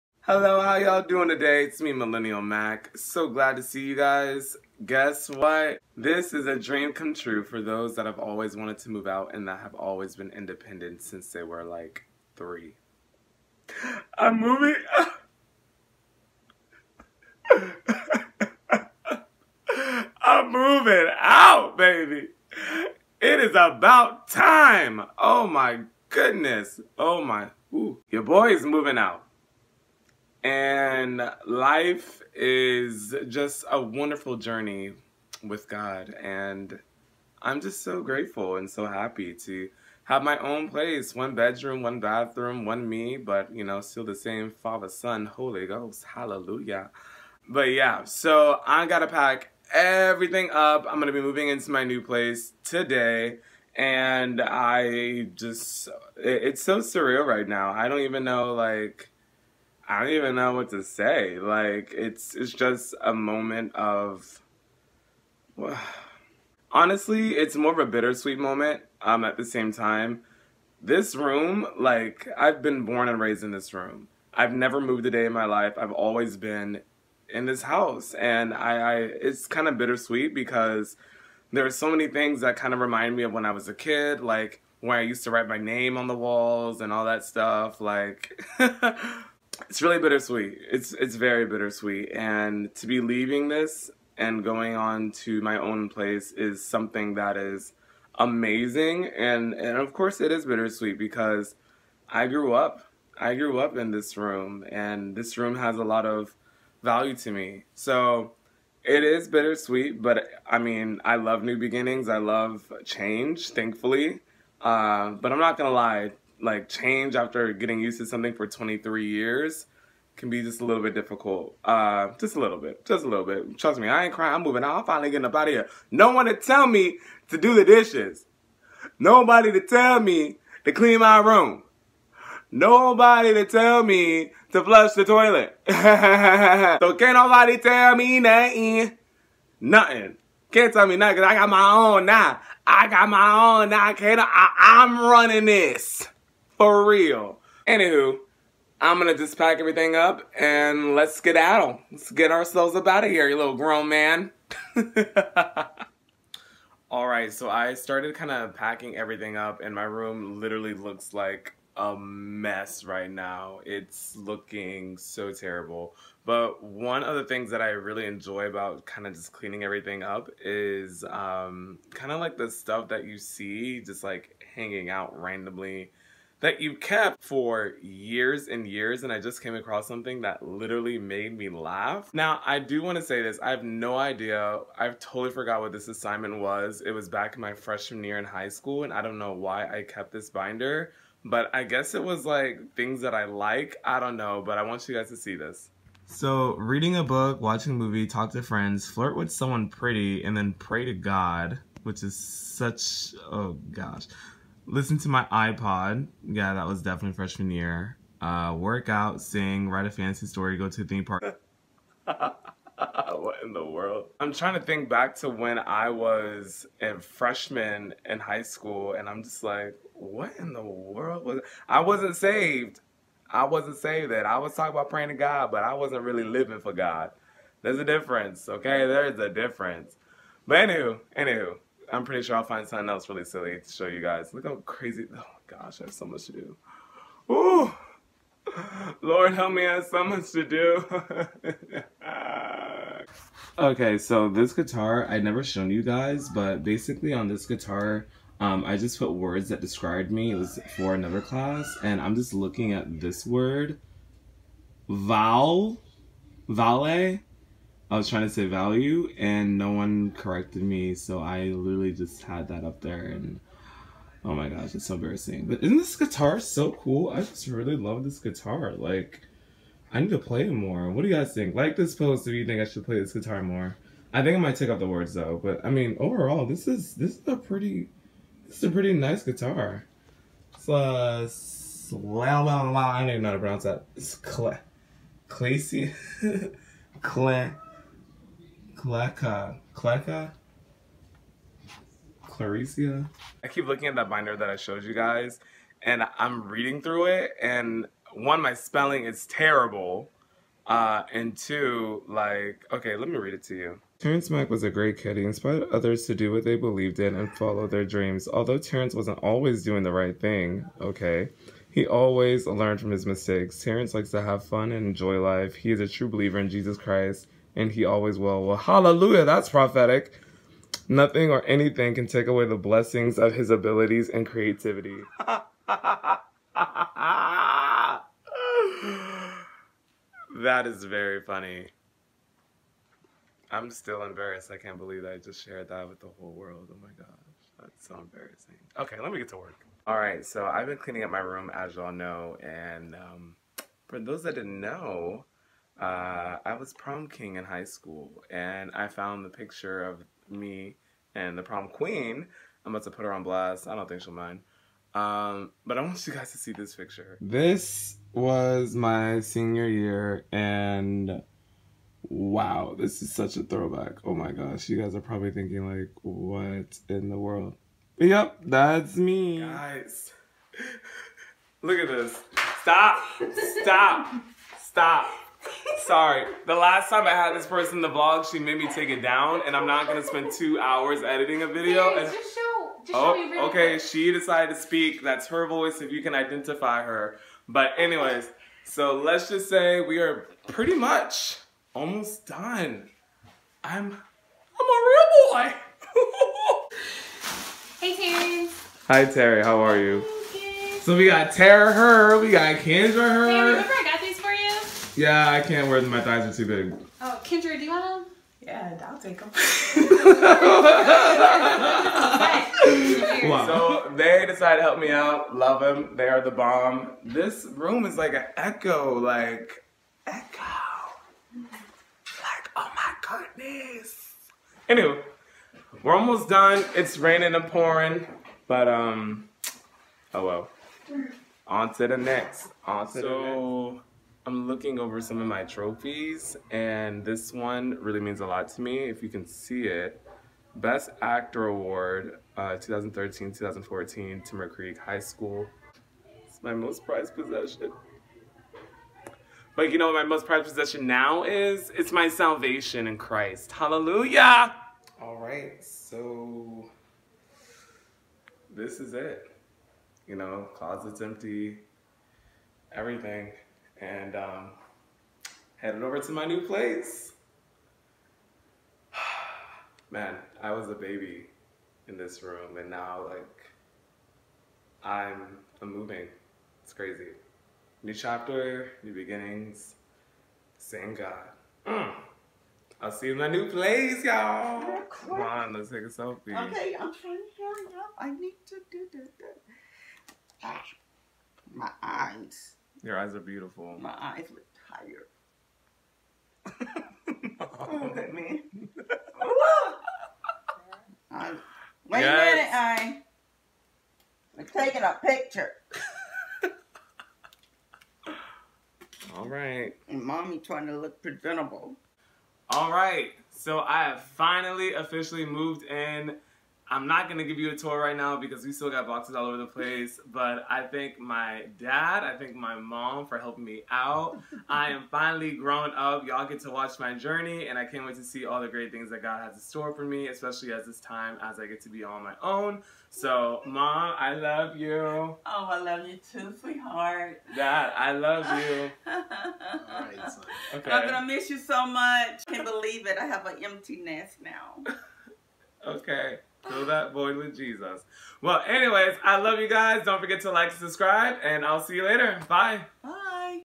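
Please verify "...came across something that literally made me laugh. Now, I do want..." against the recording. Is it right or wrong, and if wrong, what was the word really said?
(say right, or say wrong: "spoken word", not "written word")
right.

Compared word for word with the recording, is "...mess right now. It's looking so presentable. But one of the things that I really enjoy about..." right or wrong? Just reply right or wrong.
wrong.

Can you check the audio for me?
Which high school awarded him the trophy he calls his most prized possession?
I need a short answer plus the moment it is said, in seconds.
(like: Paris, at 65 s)
Timber Creek High School, at 444 s.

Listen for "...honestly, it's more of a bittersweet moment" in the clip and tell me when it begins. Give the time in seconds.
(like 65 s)
66 s.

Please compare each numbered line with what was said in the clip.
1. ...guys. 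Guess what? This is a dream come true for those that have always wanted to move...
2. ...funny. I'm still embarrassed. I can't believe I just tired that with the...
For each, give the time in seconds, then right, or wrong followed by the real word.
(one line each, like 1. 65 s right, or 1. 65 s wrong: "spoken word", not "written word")
1. 3 s right
2. 331 s wrong: "shared", not "tired".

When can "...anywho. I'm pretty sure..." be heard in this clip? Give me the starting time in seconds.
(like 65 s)
231 s.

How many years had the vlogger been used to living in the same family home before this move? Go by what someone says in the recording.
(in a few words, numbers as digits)
23.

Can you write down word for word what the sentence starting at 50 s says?
I'm gonna be moving into my new place today and I just, it's so surreal right now.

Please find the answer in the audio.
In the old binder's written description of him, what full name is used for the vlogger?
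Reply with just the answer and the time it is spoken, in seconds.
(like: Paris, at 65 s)
Terrance Mack, at 303 s.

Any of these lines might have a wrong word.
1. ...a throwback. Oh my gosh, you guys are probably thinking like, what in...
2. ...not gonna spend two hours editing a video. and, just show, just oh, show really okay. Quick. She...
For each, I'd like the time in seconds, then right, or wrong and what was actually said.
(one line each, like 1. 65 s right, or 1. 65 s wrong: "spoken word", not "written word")
1. 363 s right
2. 379 s right.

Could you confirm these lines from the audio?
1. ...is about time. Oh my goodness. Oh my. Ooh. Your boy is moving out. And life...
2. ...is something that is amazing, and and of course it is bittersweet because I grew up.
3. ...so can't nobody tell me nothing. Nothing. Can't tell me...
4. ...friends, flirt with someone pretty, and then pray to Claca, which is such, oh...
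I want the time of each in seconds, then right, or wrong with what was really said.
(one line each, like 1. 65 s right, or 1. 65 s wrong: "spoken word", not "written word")
1. 23 s right
2. 96 s right
3. 135 s right
4. 198 s wrong: "God", not "Claca".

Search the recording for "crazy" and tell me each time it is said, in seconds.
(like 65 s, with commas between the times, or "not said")
234 s, 476 s.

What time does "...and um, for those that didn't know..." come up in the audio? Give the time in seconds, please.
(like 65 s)
342 s.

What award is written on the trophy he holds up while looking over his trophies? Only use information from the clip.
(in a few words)
Best Actor Award.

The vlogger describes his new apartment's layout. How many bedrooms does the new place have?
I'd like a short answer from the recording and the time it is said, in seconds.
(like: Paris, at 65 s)
1, at 41 s.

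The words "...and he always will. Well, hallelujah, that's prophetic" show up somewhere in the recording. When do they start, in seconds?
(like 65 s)
317 s.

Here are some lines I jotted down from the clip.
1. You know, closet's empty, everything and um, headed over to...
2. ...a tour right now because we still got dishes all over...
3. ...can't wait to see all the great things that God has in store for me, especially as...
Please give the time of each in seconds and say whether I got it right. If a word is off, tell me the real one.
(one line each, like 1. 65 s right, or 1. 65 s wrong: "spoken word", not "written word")
1. 460 s right
2. 517 s wrong: "boxes", not "dishes"
3. 527 s right.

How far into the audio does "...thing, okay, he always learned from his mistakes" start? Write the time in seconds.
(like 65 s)
310 s.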